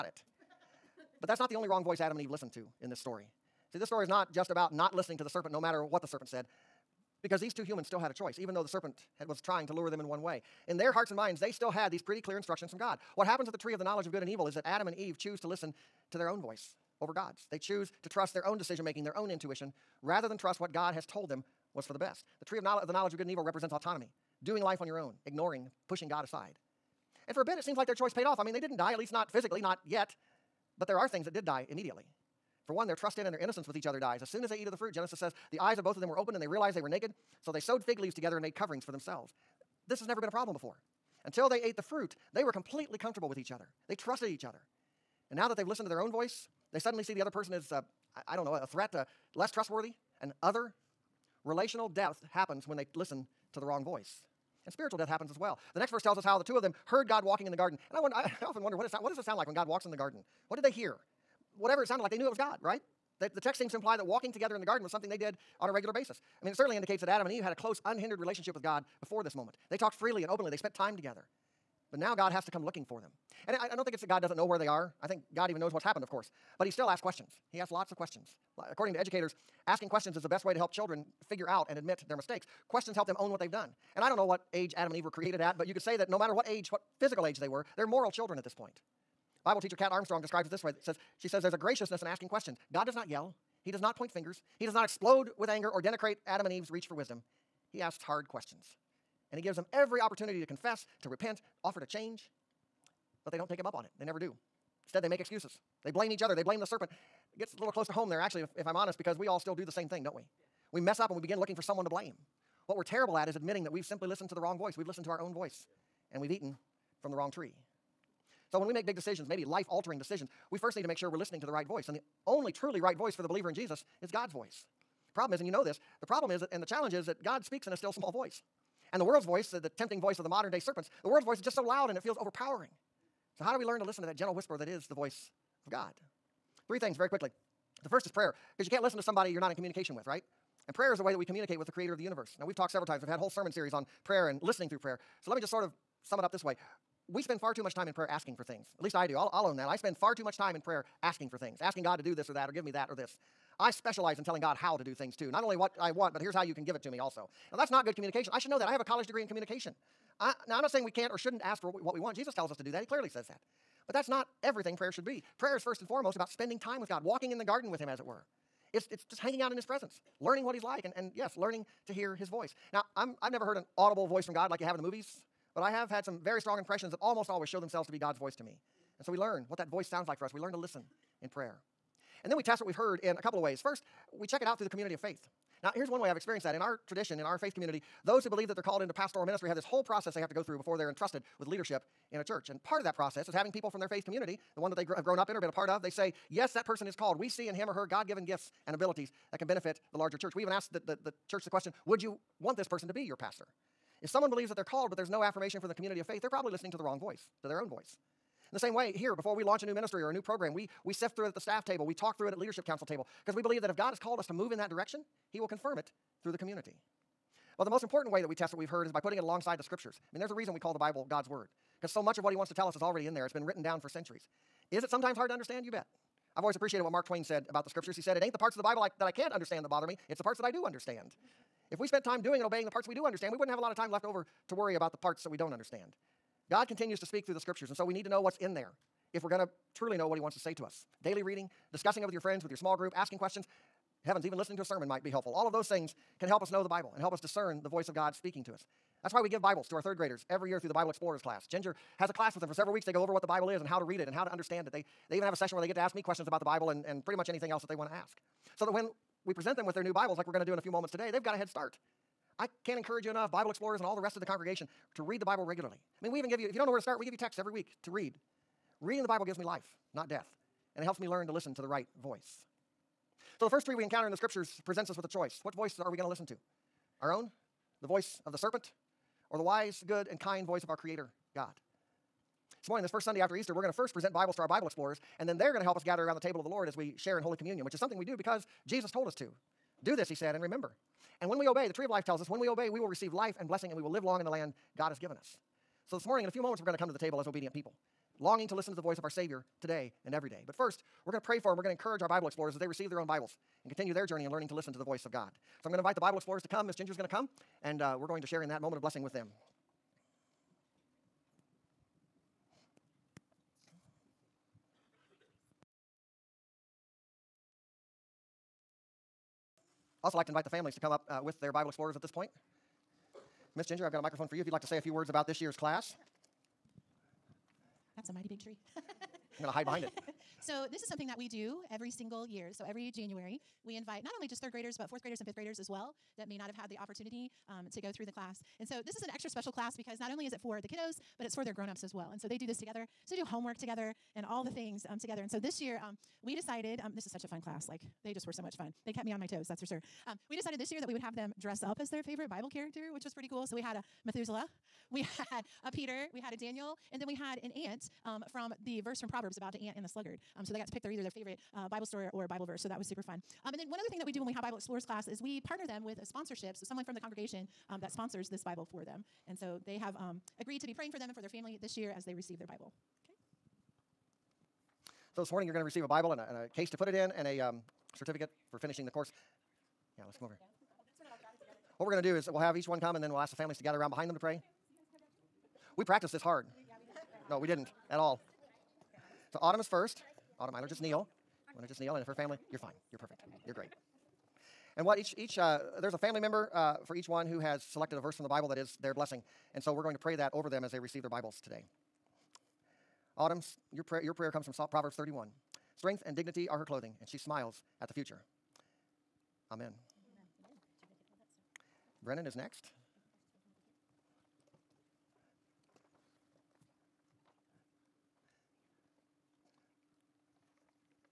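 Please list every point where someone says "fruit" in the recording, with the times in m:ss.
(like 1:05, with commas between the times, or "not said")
0:34, 0:41.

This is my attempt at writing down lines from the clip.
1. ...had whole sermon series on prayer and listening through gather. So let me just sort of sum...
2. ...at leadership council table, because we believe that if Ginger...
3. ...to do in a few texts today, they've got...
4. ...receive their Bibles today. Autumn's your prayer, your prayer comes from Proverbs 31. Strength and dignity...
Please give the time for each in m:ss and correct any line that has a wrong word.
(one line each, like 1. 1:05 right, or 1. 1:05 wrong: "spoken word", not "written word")
1. 2:23 wrong: "prayer", not "gather"
2. 3:32 wrong: "God", not "Ginger"
3. 4:20 wrong: "moments", not "texts"
4. 6:40 right.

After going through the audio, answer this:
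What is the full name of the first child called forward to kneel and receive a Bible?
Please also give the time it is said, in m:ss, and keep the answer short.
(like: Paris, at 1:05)
Autumn Eiler, at 6:30.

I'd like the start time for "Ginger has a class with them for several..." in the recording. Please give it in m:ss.
4:11.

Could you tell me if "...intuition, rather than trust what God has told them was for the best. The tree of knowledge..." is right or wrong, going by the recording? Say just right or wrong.
right.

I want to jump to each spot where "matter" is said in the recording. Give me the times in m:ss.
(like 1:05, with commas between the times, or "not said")
0:05, 1:26.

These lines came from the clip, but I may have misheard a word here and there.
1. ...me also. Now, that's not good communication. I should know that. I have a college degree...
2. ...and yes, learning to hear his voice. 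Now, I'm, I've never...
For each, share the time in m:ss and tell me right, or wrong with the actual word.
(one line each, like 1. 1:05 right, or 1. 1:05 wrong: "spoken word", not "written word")
1. 2:36 right
2. 2:50 right.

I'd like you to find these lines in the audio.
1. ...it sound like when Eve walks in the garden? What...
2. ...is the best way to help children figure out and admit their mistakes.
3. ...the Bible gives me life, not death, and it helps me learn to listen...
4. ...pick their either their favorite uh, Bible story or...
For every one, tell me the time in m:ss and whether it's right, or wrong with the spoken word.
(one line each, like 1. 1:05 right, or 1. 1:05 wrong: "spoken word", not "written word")
1. 0:59 wrong: "God", not "Eve"
2. 1:20 right
3. 4:29 right
4. 6:00 right.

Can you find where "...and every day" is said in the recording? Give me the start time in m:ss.
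5:00.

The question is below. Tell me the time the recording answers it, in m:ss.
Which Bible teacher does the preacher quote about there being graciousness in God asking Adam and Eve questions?
1:29.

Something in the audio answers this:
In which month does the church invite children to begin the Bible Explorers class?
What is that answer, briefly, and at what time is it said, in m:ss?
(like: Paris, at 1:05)
January, at 5:32.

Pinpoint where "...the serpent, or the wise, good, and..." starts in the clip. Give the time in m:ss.
4:38.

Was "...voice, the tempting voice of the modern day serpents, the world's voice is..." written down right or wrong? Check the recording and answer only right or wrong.
right.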